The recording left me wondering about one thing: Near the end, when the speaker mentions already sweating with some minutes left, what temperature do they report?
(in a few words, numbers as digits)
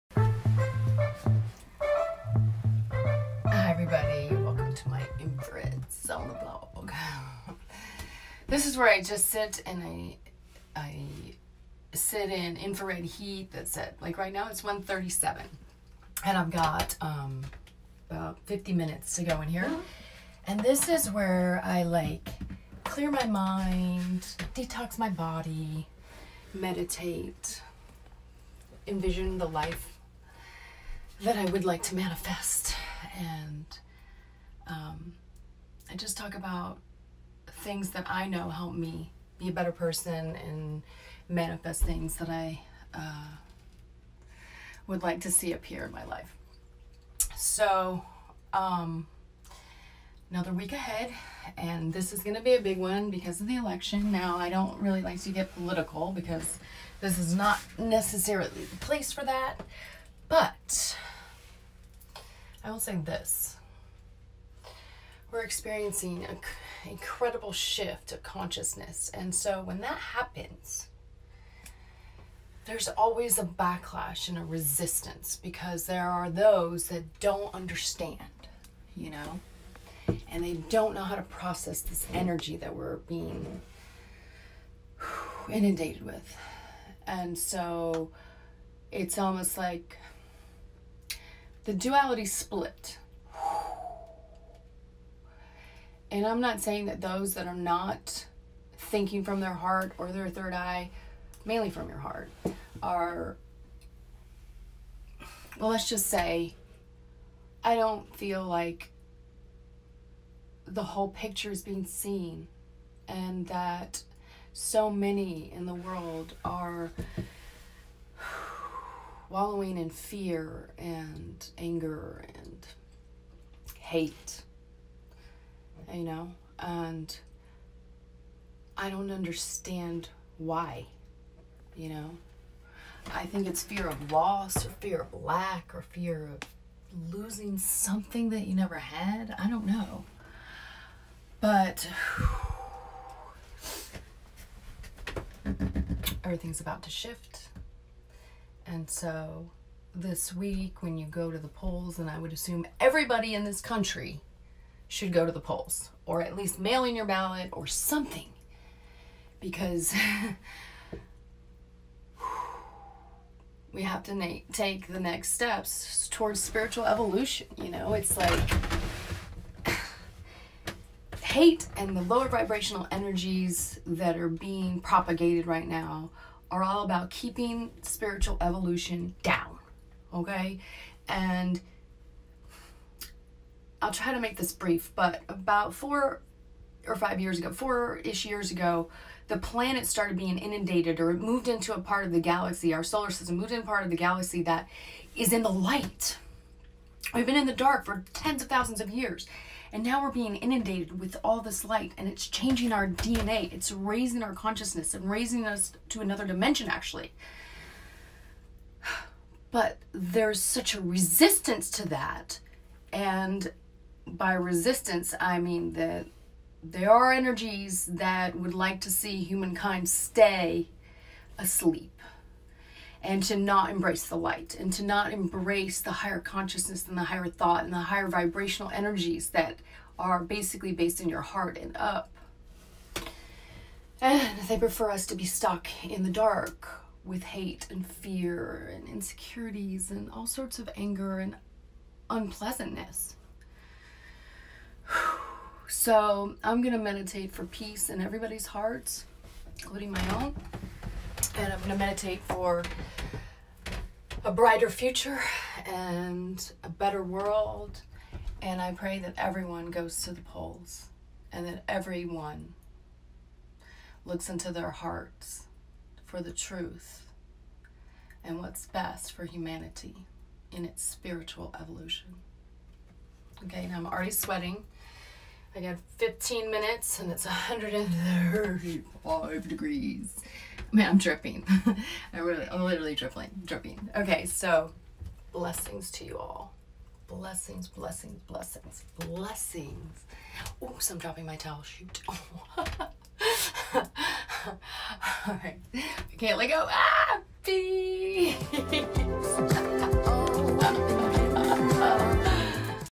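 135.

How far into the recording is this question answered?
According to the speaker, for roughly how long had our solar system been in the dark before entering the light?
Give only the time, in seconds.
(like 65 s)
198 s.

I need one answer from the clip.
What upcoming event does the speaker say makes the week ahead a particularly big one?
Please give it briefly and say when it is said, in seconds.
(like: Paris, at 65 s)
the election, at 53 s.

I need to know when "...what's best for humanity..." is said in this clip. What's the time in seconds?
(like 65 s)
268 s.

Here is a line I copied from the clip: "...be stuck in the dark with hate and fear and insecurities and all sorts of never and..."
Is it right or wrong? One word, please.
wrong.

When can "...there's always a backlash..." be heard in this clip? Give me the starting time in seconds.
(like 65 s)
72 s.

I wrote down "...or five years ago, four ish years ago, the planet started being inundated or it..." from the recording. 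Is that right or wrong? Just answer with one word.
right.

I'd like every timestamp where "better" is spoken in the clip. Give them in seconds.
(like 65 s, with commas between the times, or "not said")
39 s, 256 s.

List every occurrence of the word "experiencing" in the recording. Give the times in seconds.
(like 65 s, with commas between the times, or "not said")
65 s.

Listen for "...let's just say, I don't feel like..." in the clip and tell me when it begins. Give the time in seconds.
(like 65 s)
105 s.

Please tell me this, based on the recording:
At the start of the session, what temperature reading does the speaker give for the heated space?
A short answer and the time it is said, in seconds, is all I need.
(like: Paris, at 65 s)
137, at 14 s.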